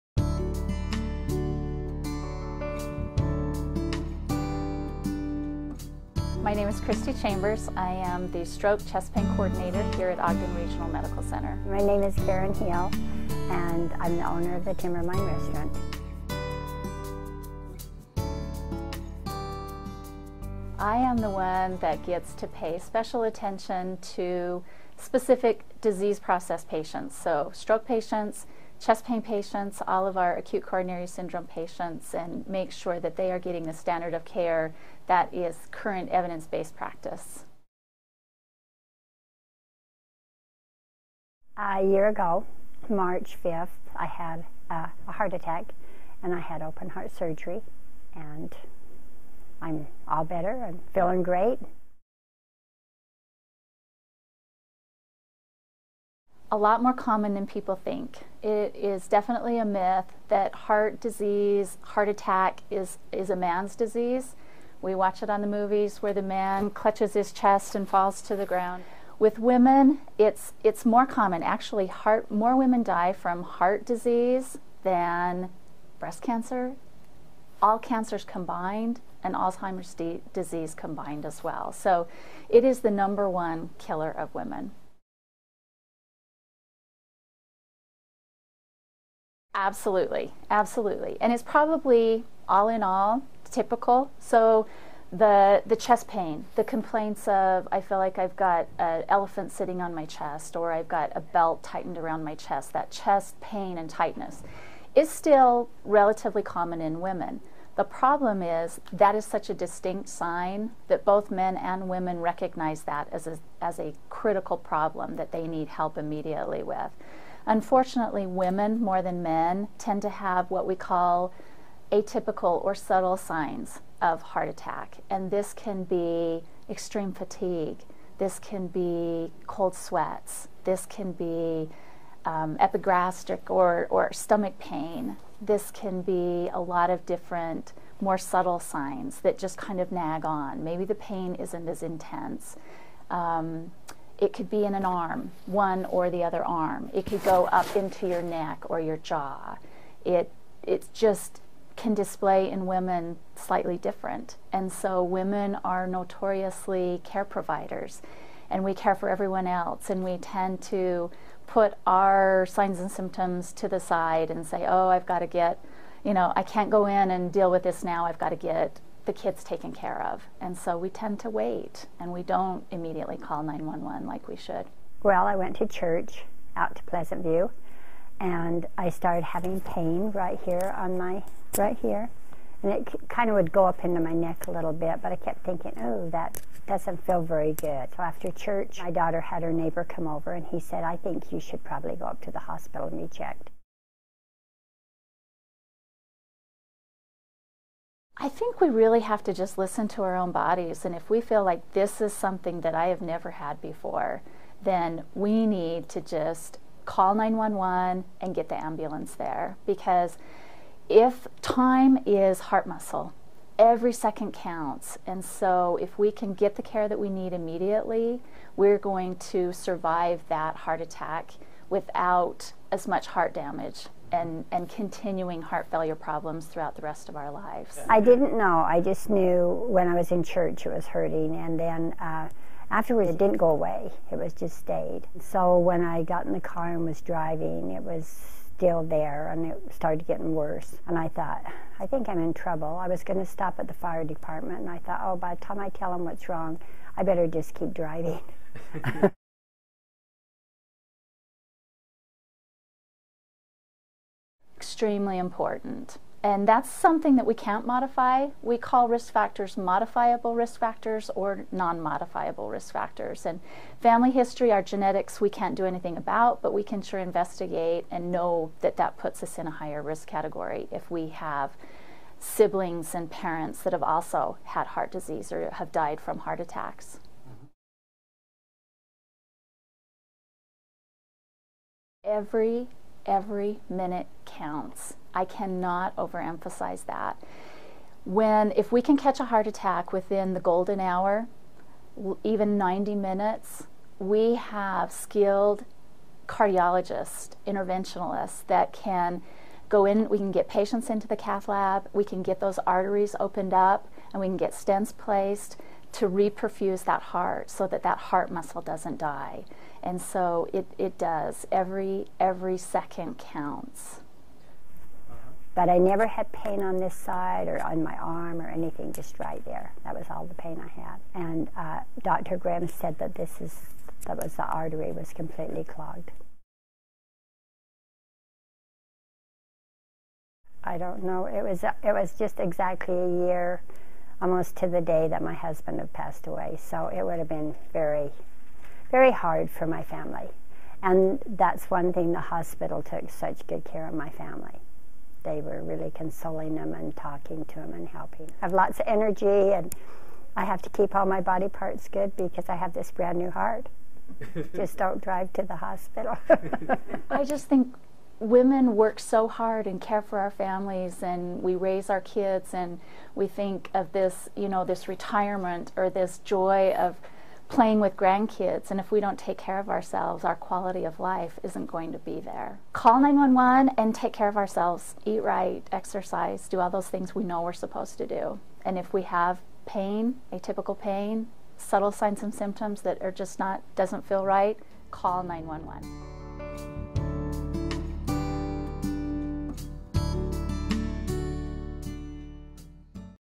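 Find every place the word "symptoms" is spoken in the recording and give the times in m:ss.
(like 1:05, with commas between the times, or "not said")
2:42, 6:22.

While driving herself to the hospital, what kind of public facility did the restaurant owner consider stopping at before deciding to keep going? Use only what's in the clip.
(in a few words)
Fire department.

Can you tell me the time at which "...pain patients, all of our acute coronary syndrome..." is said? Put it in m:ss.
0:29.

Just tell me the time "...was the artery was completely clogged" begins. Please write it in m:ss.
5:24.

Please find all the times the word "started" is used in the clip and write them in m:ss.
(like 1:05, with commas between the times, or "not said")
2:58, 3:59.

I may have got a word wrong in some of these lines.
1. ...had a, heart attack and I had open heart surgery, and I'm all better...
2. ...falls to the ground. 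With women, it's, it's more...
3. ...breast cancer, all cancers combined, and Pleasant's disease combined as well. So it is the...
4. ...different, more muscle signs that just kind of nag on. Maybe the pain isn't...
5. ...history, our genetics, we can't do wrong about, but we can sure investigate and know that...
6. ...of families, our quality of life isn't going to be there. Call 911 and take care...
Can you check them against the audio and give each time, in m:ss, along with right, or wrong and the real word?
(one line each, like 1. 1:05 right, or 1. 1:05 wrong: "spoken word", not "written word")
1. 0:44 right
2. 1:07 right
3. 1:15 wrong: "Alzheimer", not "Pleasant"
4. 2:17 wrong: "subtle", not "muscle"
5. 4:24 wrong: "anything", not "wrong"
6. 6:09 wrong: "ourselves", not "families".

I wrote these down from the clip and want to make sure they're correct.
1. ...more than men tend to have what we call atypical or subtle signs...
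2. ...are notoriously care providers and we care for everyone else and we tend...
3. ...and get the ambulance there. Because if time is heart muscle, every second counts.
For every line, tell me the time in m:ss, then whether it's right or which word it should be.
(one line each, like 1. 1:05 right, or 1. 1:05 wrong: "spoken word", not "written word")
1. 1:58 right
2. 2:35 right
3. 3:28 right.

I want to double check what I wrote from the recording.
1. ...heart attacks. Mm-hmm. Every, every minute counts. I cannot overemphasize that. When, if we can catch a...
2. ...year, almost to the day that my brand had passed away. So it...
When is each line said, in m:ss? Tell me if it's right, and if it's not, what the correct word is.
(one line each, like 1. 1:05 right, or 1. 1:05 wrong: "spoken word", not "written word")
1. 4:36 right
2. 5:33 wrong: "husband", not "brand".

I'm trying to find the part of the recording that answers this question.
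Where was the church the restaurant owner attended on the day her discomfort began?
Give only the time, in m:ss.
2:56.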